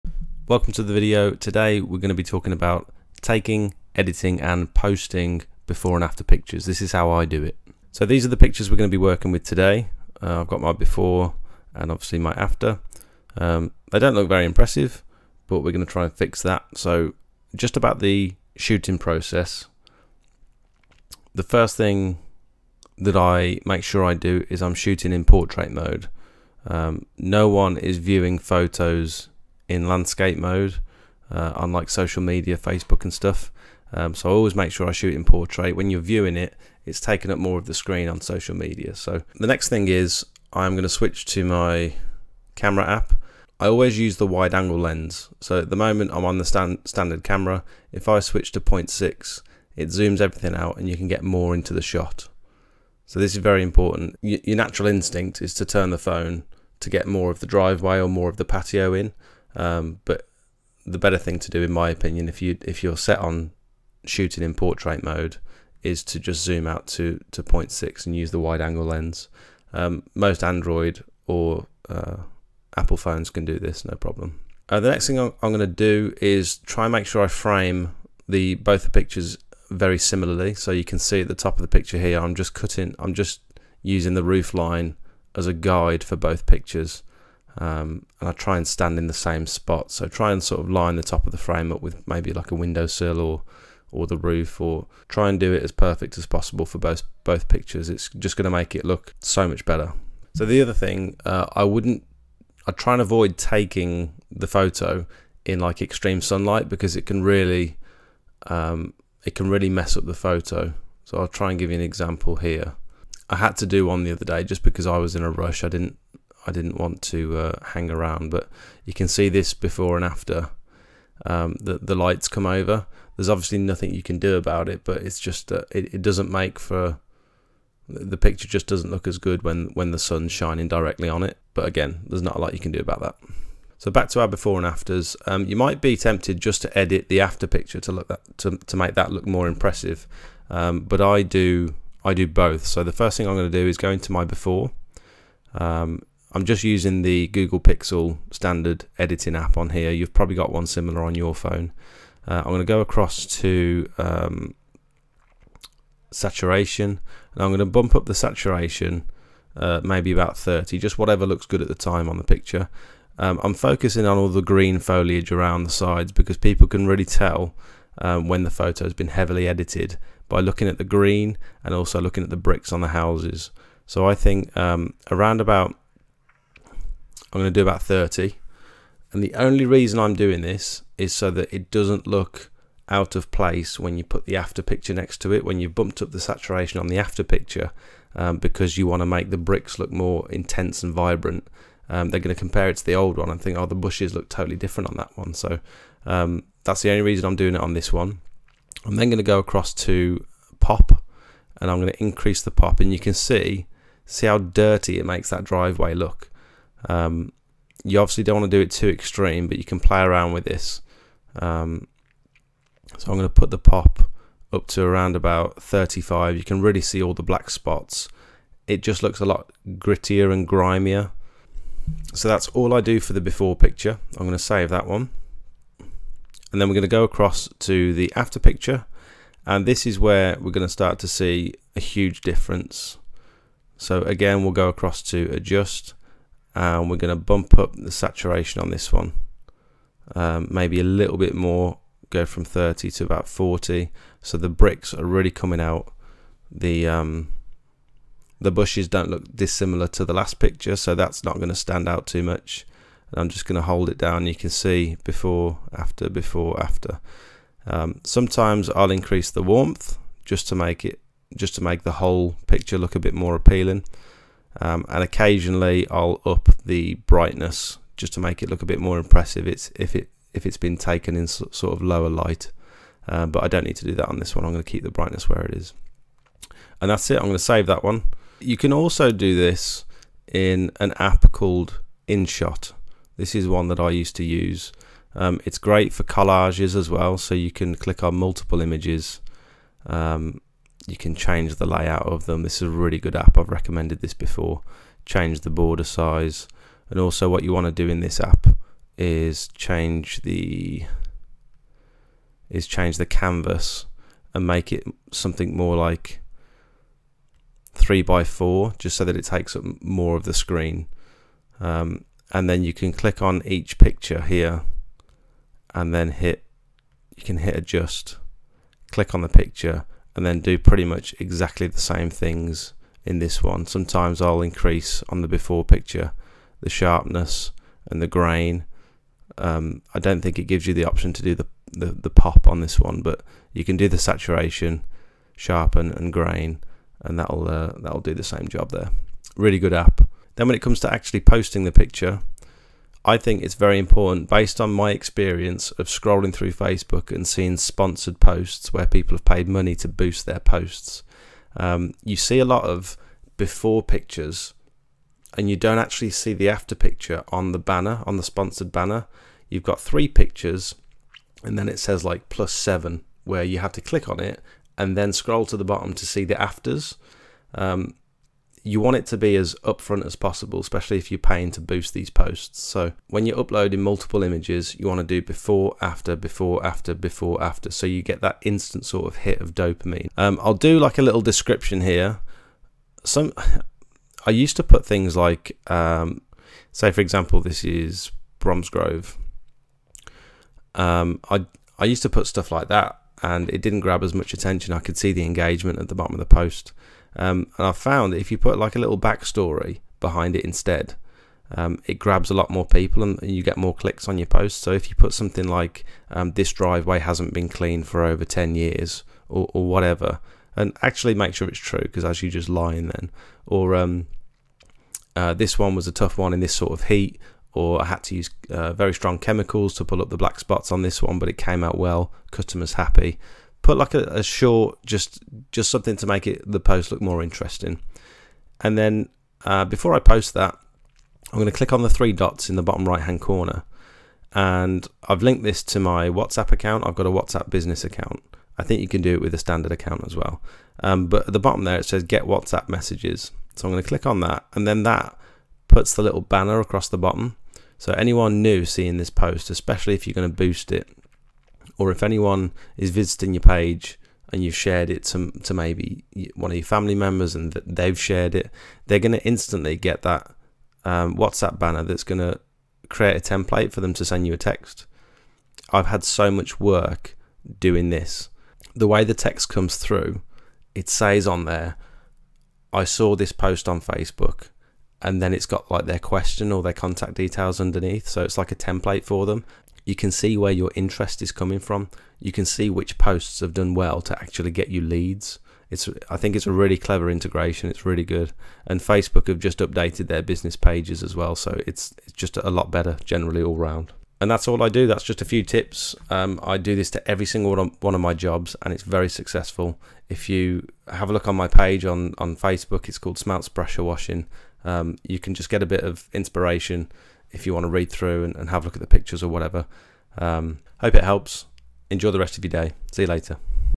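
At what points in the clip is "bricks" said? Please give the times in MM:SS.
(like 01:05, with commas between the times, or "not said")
02:52, 03:09, 04:04.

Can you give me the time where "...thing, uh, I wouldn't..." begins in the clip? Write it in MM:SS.
01:40.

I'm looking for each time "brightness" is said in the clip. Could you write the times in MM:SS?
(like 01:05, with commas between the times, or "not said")
04:27, 04:34.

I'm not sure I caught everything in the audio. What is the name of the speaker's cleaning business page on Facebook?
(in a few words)
Smout's Pressure Washing.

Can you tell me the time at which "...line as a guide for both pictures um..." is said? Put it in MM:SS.
01:24.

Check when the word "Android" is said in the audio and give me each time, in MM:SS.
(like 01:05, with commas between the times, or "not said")
01:10.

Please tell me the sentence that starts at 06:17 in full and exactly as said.
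So you get that instant sort of hit of dopamine.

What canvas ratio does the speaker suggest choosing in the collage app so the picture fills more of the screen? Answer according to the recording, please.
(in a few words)
3 by 4.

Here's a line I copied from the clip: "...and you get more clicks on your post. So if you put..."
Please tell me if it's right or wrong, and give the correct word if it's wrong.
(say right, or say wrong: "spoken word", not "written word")
right.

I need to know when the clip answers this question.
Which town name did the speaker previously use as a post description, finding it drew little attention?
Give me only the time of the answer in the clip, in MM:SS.
06:28.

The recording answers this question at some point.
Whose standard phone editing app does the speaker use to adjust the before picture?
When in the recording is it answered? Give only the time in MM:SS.
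02:27.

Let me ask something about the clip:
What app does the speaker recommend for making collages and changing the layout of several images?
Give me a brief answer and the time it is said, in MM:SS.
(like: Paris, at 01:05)
InShot, at 04:42.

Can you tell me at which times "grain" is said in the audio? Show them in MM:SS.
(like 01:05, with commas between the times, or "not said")
05:28, 05:36.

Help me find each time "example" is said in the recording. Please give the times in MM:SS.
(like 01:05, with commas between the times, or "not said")
01:51, 06:27.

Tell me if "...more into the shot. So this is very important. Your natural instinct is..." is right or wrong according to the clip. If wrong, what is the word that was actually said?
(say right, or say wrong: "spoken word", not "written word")
right.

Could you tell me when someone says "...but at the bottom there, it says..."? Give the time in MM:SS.
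07:21.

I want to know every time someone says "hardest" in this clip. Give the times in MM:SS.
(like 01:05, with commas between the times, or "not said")
not said.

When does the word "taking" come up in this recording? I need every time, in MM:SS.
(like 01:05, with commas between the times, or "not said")
00:03, 00:36, 01:43.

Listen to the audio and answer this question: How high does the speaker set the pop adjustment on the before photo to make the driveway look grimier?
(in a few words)
35.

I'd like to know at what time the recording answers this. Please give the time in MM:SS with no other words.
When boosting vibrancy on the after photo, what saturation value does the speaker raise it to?
04:03.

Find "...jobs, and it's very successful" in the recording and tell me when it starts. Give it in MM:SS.
08:18.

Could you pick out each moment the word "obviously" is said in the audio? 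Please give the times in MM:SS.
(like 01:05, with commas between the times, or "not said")
00:11, 02:03, 03:27.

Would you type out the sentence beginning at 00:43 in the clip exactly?
I always use the wide angle lens.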